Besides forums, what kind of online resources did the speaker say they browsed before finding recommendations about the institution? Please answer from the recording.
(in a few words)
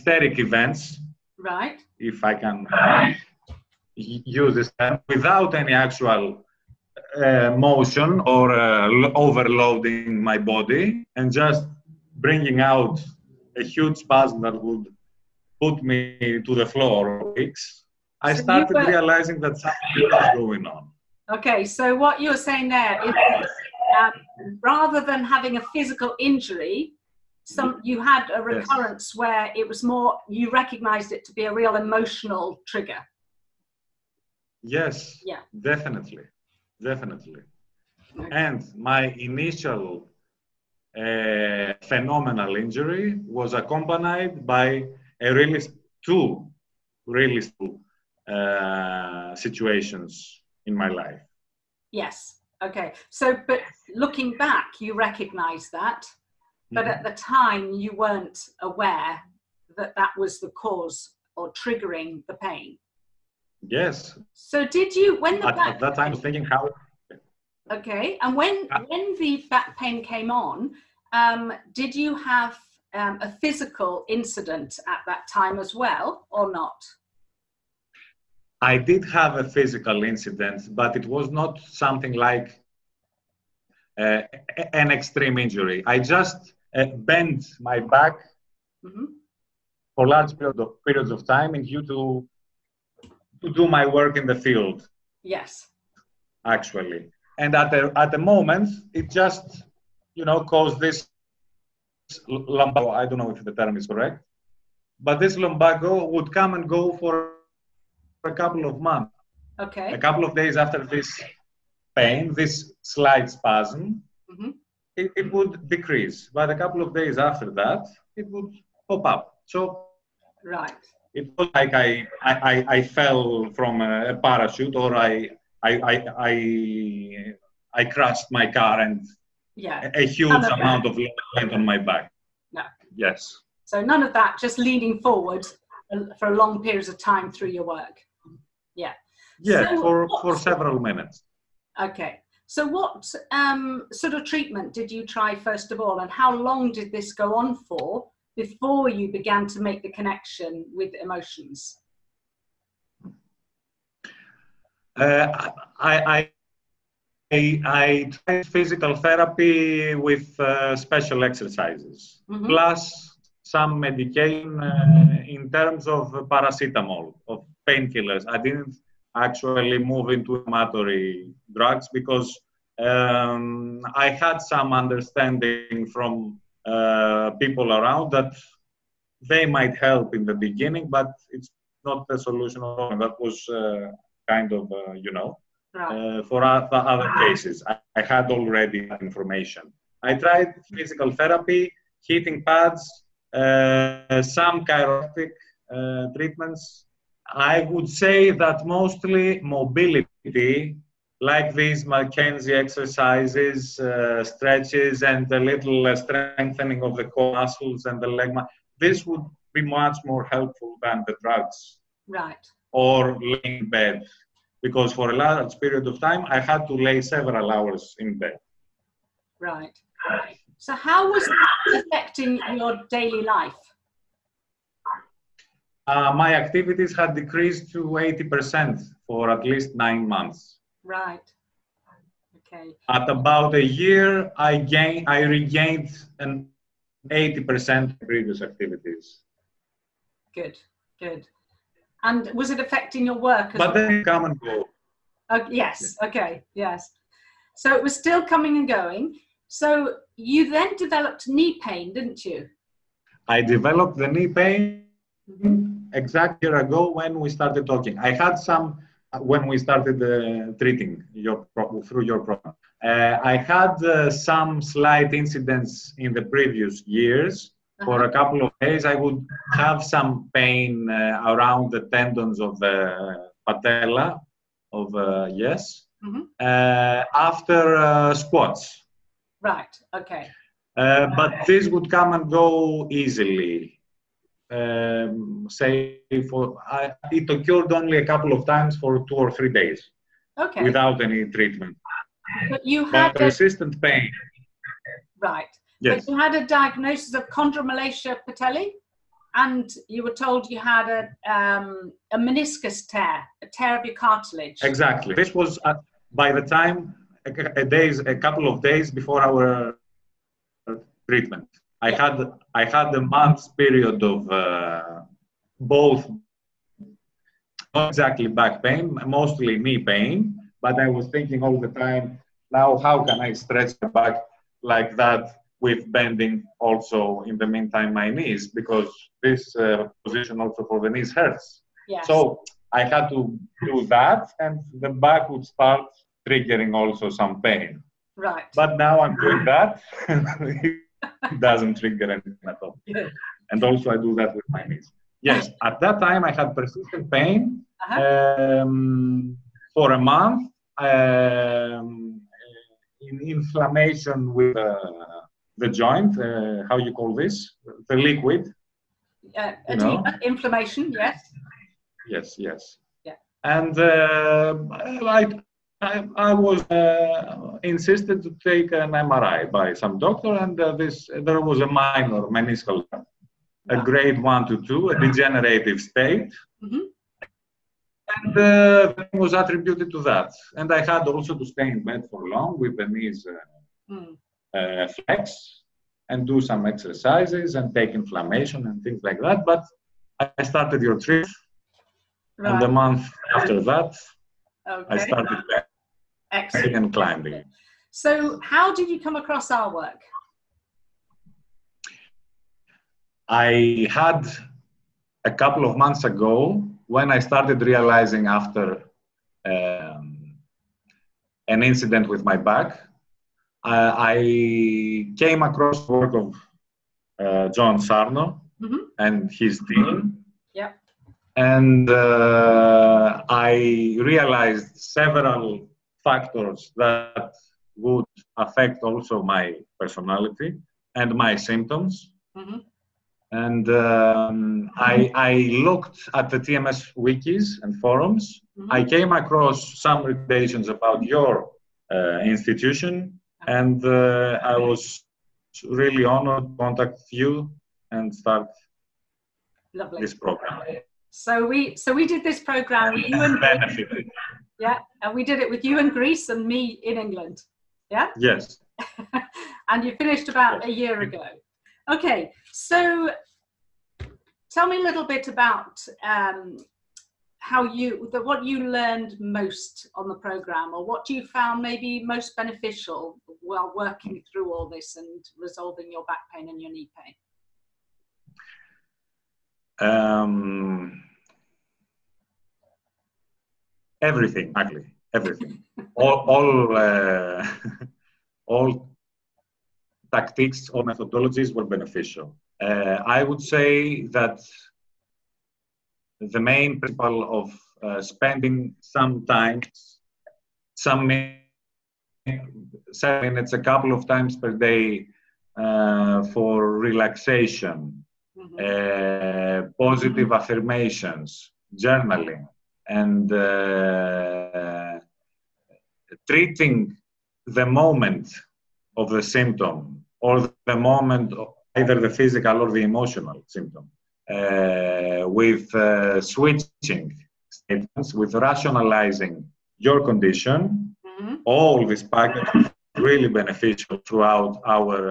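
TMS wikis.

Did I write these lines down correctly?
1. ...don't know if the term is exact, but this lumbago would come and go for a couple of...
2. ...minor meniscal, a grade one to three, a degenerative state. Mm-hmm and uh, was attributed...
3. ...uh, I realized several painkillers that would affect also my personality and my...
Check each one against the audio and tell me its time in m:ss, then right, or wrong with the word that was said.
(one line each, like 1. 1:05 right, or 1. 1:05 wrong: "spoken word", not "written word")
1. 1:43 wrong: "correct", not "exact"
2. 6:11 wrong: "two", not "three"
3. 7:01 wrong: "factors", not "painkillers".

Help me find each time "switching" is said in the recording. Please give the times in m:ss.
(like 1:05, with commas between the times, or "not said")
8:46.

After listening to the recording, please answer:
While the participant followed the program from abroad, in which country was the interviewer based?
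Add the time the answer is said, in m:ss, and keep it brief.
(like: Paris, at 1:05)
England, at 7:36.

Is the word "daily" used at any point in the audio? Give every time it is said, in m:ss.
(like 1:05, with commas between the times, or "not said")
3:42.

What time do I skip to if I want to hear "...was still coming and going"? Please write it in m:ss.
4:07.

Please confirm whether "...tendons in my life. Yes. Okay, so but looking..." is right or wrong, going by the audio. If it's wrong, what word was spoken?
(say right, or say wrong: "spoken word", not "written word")
wrong: "situations", not "tendons".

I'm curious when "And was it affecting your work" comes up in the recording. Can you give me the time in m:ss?
4:02.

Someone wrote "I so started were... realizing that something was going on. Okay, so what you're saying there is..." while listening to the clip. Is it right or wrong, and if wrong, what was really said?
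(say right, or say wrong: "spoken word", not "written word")
right.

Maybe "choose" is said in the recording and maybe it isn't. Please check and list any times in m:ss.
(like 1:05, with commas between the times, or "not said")
not said.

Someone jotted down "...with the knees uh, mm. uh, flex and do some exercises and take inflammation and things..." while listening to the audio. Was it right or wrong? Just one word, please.
right.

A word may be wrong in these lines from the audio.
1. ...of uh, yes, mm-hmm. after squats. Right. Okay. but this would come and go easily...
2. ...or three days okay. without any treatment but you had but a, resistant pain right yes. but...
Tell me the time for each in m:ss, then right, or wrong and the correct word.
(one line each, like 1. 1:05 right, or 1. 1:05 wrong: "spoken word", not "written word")
1. 4:34 right
2. 4:49 right.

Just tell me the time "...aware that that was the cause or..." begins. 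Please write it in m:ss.
0:58.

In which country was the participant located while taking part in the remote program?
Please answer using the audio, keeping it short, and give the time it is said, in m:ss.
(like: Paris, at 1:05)
Greece, at 7:35.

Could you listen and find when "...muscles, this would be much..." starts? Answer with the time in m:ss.
3:28.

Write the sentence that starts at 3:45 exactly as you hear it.
Uh, my activities had decreased to 80% for at least nine months.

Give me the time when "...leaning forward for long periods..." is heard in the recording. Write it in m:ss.
2:14.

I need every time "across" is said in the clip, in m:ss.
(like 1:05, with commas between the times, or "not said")
6:39, 6:55, 7:19.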